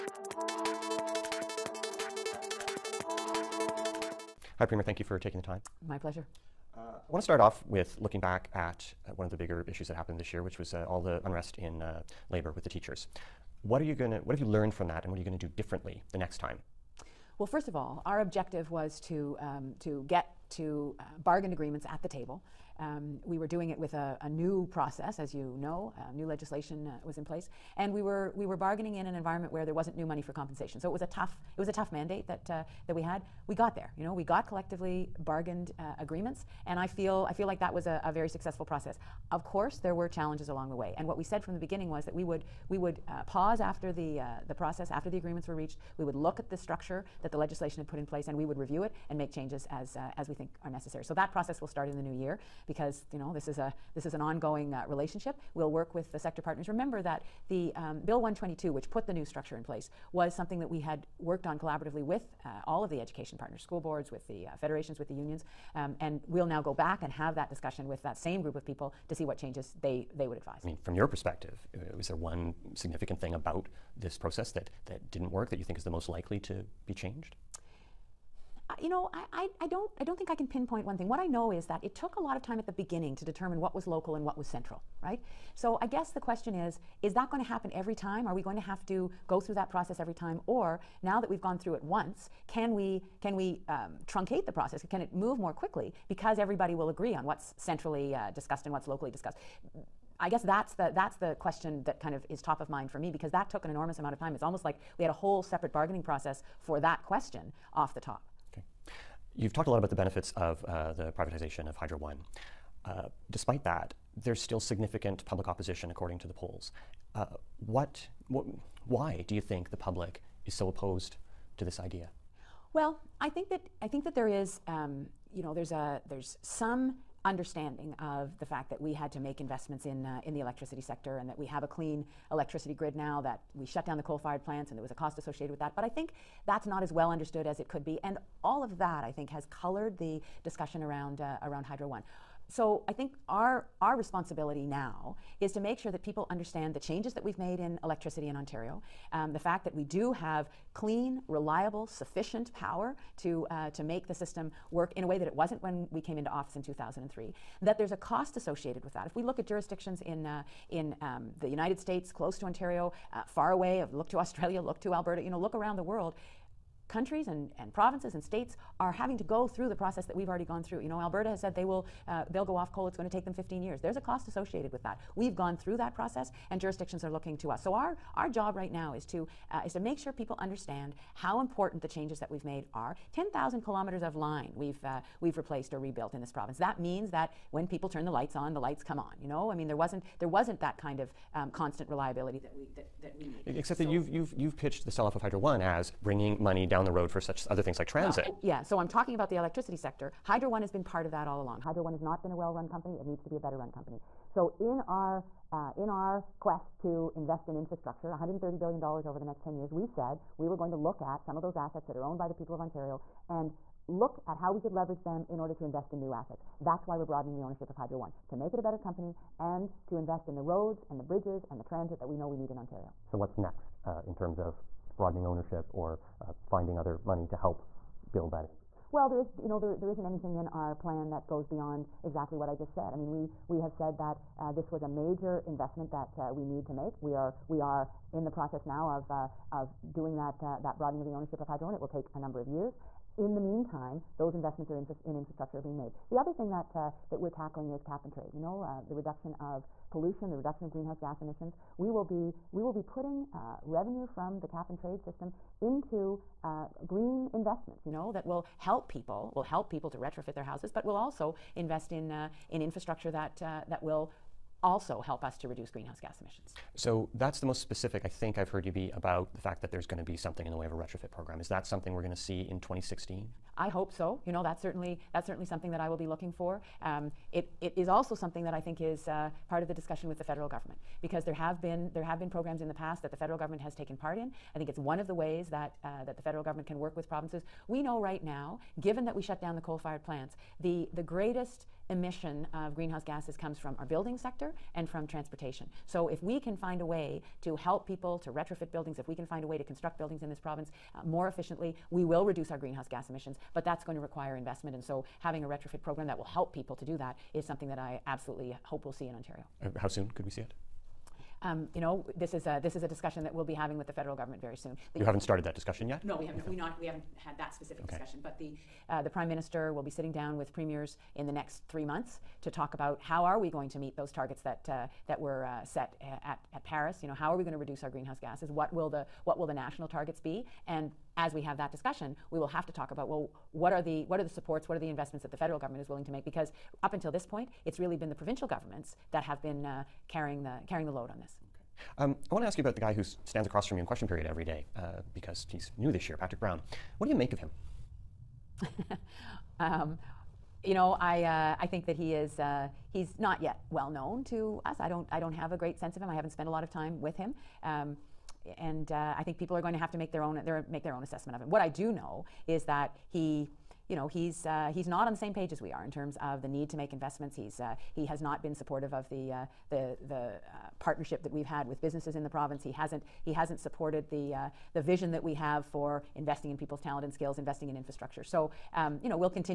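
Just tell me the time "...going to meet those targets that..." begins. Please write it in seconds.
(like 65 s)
323 s.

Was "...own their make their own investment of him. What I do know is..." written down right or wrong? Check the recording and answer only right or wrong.
wrong.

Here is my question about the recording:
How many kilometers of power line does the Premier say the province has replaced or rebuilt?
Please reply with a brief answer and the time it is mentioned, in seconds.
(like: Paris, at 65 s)
10,000, at 183 s.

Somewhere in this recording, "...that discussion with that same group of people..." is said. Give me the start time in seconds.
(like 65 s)
67 s.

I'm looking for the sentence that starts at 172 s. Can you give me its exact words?
It's going to take them 15 years.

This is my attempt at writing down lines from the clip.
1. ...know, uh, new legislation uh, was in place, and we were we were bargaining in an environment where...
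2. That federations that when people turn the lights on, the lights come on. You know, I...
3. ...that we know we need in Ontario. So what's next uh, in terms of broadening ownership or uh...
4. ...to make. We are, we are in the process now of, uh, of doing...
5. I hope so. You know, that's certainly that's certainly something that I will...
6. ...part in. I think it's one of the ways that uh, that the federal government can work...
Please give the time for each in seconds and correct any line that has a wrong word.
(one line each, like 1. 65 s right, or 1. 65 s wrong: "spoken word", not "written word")
1. 25 s right
2. 186 s wrong: "means", not "federations"
3. 221 s right
4. 236 s right
5. 273 s right
6. 283 s right.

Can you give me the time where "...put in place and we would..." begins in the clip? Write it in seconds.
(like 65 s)
47 s.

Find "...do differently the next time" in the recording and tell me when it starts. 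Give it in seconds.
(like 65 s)
15 s.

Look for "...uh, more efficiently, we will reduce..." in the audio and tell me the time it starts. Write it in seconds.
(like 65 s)
300 s.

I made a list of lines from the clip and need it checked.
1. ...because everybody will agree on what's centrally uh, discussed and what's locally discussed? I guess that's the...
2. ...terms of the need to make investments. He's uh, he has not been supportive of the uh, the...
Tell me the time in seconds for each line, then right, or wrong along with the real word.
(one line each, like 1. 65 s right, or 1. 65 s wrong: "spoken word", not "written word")
1. 96 s right
2. 365 s right.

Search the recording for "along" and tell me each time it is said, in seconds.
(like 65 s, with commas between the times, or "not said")
40 s, 201 s.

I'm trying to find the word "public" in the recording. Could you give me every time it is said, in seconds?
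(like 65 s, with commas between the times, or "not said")
115 s, 119 s.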